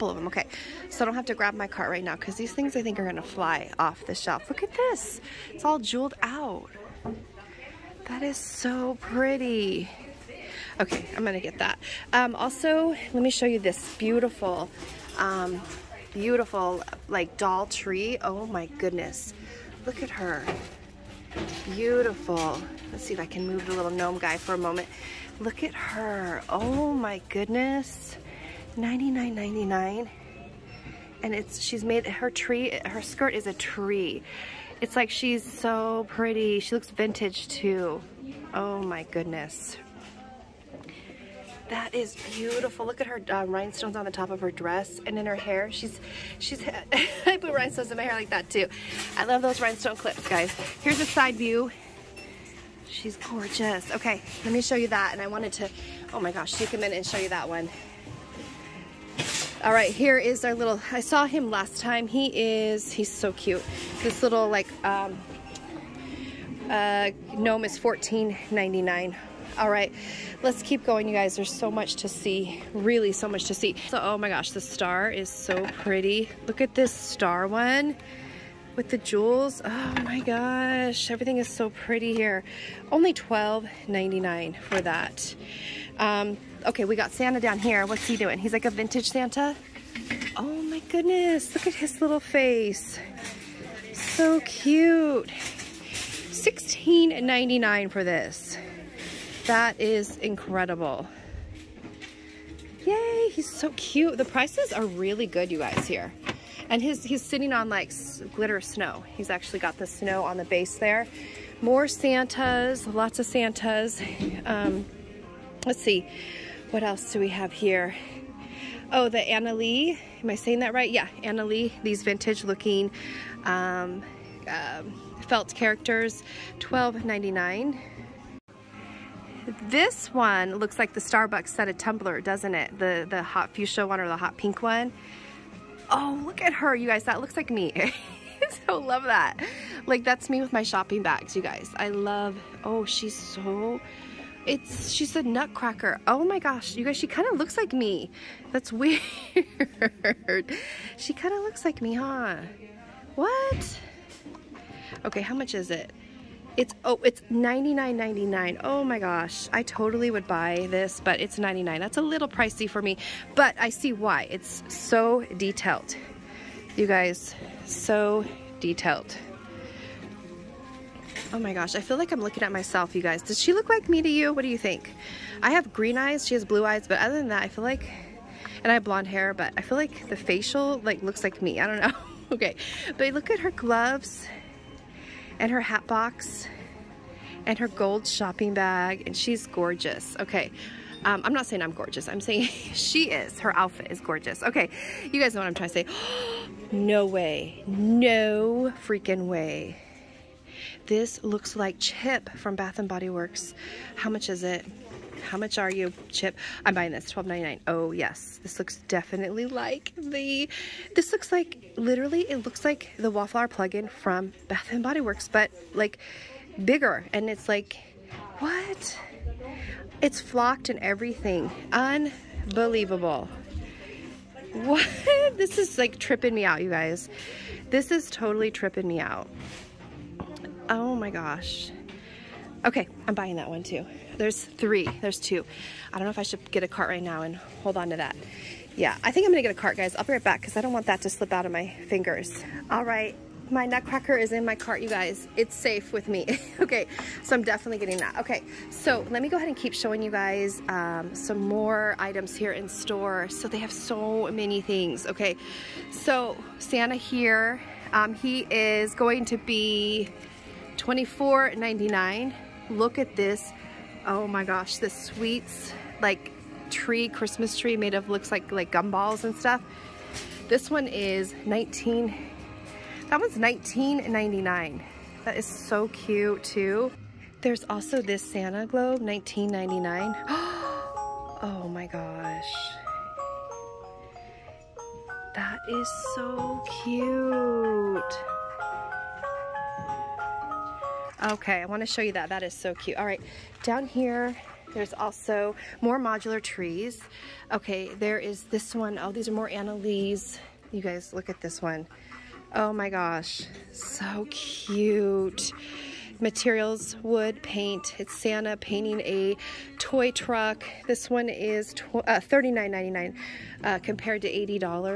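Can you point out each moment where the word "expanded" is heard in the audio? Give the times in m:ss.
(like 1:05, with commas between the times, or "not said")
not said.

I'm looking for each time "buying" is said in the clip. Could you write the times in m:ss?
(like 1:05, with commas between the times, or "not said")
3:26, 3:53.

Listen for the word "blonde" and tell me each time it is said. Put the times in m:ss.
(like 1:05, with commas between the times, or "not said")
2:58.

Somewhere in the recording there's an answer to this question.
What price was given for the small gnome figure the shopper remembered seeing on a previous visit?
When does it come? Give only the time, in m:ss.
1:07.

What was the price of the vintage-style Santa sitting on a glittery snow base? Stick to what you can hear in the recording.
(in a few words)
$16.99.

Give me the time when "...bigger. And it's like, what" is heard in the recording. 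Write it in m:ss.
3:36.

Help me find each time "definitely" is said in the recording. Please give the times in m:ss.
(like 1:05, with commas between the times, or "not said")
3:28, 4:07.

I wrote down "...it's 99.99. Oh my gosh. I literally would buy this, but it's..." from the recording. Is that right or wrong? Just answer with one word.
wrong.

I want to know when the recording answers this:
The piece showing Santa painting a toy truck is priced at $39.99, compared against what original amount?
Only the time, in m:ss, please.
5:14.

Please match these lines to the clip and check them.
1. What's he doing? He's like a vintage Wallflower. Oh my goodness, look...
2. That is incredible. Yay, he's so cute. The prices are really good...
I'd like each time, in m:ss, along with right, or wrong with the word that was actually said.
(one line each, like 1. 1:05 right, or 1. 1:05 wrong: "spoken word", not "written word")
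1. 1:27 wrong: "Santa", not "Wallflower"
2. 1:39 right.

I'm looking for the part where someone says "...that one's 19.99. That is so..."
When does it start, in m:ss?
4:33.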